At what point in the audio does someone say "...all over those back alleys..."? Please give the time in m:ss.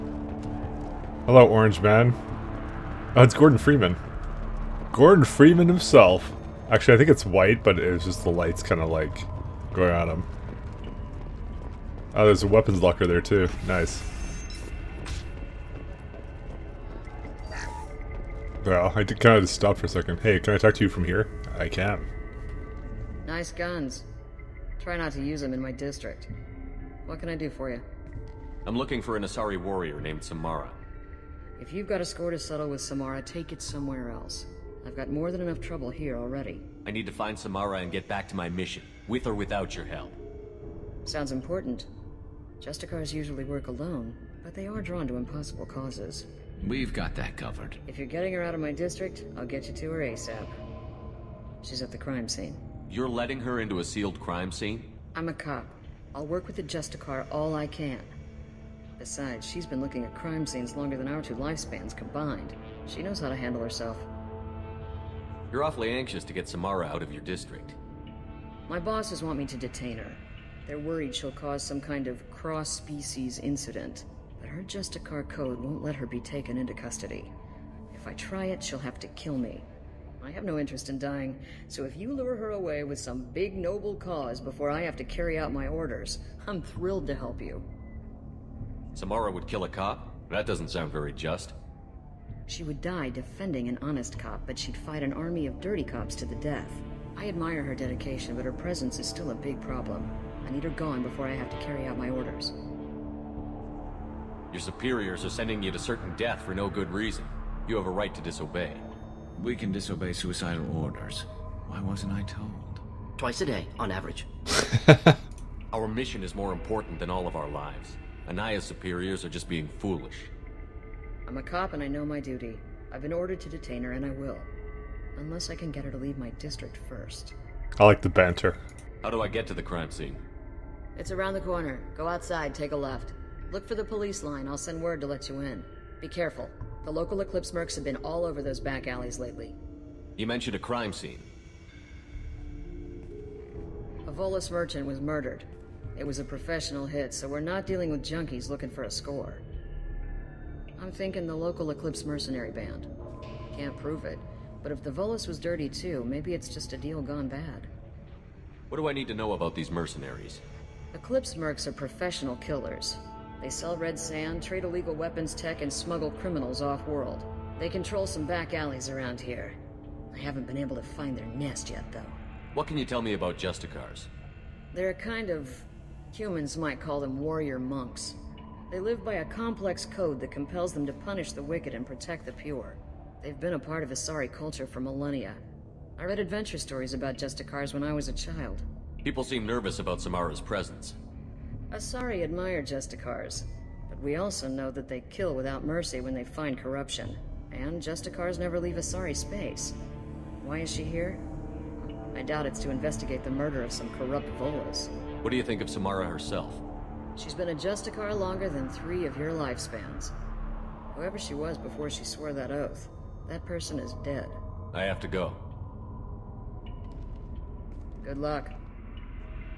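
2:17.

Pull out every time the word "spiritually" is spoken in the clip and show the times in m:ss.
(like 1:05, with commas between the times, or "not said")
not said.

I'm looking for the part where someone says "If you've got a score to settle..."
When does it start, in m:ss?
0:31.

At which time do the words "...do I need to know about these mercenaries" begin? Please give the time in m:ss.
2:38.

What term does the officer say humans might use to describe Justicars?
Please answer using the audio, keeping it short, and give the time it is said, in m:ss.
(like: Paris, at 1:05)
warrior monks, at 2:57.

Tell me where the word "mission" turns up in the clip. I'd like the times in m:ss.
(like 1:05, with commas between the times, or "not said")
0:38, 1:55.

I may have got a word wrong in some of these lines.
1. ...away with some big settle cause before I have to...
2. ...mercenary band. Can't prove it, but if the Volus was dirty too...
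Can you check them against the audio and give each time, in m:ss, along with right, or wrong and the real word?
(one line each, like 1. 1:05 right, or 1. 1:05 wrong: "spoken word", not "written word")
1. 1:22 wrong: "noble", not "settle"
2. 2:32 right.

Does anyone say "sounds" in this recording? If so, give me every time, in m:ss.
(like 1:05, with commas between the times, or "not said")
0:41, 1:30.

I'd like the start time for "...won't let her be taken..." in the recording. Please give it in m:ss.
1:15.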